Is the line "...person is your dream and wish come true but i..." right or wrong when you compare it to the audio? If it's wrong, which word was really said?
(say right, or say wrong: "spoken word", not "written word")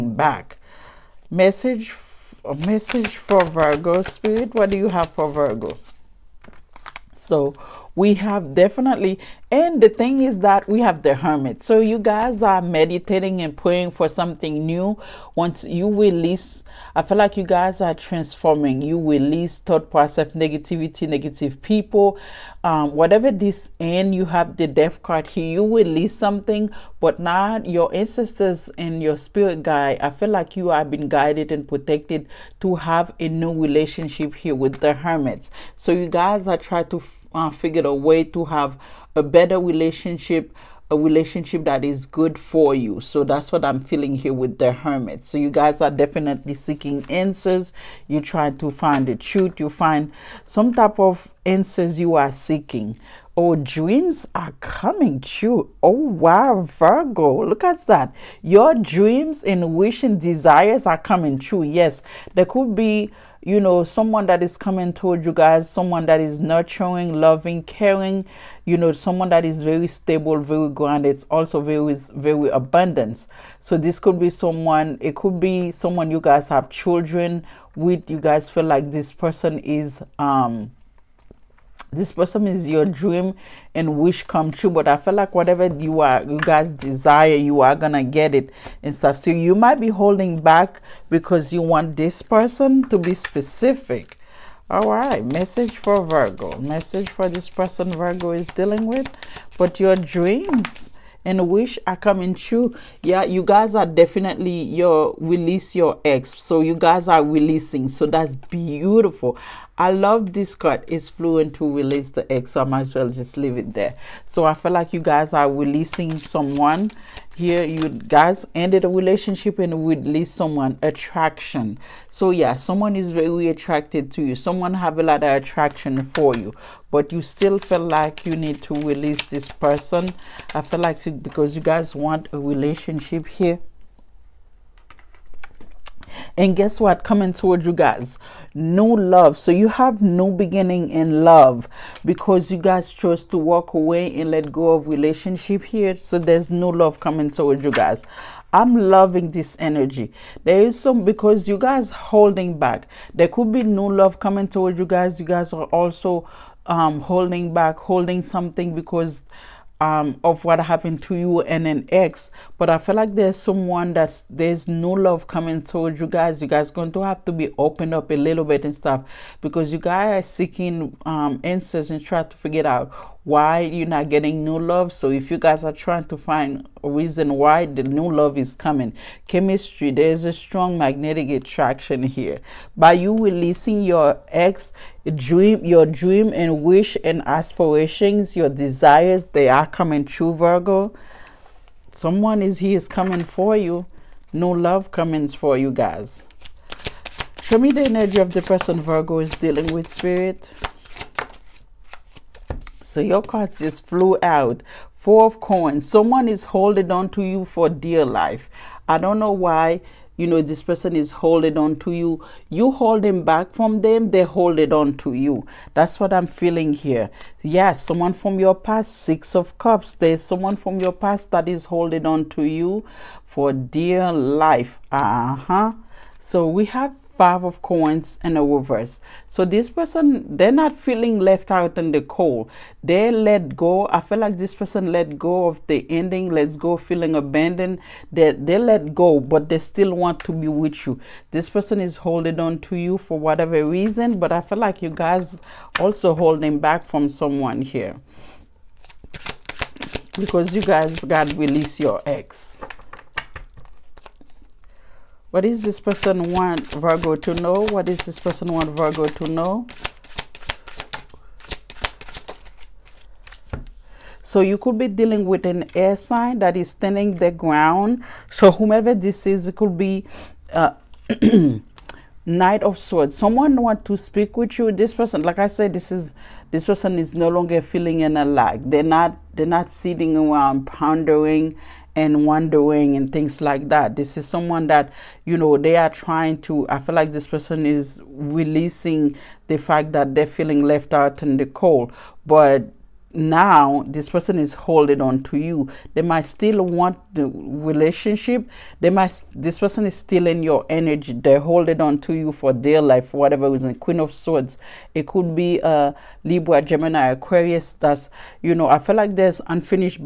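right.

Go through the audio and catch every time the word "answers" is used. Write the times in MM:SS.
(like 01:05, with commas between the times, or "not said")
00:47, 00:51, 02:51.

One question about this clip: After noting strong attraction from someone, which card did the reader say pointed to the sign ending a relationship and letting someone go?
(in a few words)
The Death card.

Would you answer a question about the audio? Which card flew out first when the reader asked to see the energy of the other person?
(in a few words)
Four of Coins.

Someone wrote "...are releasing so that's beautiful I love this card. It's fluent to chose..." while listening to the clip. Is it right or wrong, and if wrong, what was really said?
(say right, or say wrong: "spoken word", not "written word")
wrong: "release", not "chose".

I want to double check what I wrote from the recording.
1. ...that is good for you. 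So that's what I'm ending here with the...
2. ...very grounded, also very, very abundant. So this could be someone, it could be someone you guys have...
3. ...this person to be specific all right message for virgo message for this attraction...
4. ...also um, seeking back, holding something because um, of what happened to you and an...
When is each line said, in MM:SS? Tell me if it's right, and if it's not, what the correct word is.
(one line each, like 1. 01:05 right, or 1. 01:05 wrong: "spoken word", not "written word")
1. 00:41 wrong: "feeling", not "ending"
2. 01:10 right
3. 01:31 wrong: "person", not "attraction"
4. 02:35 wrong: "holding", not "seeking".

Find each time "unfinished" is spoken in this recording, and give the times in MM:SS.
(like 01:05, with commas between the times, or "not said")
05:09.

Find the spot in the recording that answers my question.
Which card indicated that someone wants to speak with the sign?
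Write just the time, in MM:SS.
04:32.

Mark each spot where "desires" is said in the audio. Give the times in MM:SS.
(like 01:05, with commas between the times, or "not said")
01:00, 01:26, 03:08.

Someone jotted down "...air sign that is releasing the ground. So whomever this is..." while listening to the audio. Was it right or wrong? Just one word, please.
wrong.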